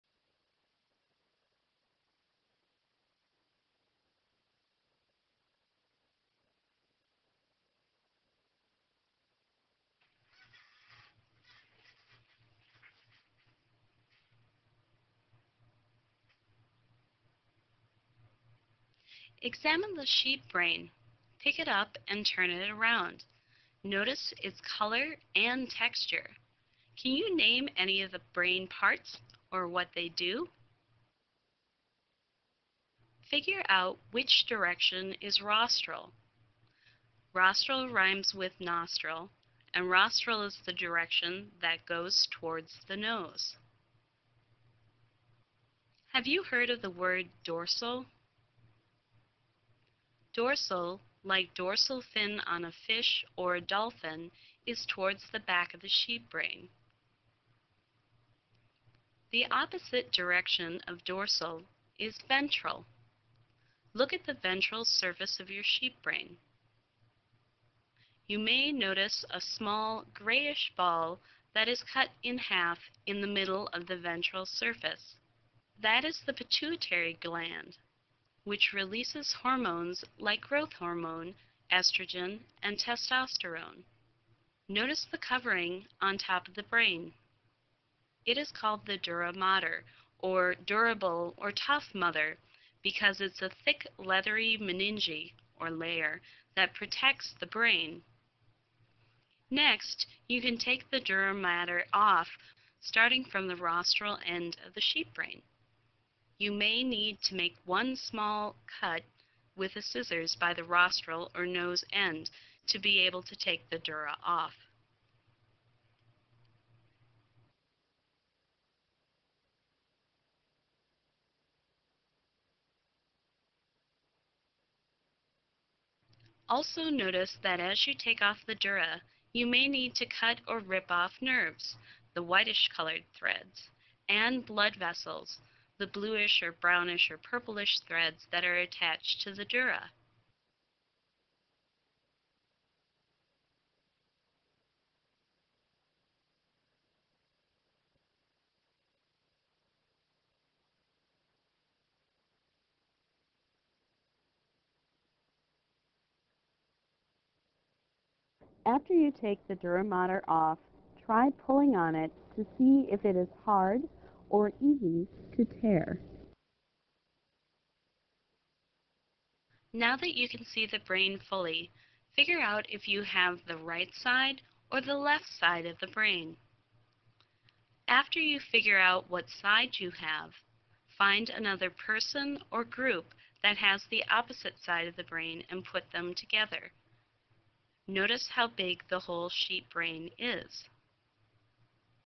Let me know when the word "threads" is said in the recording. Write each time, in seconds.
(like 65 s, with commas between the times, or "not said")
133 s, 137 s.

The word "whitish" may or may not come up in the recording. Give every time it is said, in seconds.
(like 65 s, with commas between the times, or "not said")
132 s.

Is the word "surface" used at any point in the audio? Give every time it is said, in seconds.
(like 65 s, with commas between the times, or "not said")
64 s, 74 s.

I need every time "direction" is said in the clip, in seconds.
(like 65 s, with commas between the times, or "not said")
34 s, 40 s, 60 s.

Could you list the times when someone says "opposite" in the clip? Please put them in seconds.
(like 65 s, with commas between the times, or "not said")
59 s, 184 s.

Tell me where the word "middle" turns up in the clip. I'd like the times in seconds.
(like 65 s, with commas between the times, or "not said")
73 s.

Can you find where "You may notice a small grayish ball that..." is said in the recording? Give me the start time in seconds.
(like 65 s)
68 s.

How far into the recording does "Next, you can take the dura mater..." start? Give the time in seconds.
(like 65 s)
99 s.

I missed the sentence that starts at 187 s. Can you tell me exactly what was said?
Notice how big the whole sheep brain is.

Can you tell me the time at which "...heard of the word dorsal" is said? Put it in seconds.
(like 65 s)
46 s.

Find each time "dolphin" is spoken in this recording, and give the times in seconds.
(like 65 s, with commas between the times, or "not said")
53 s.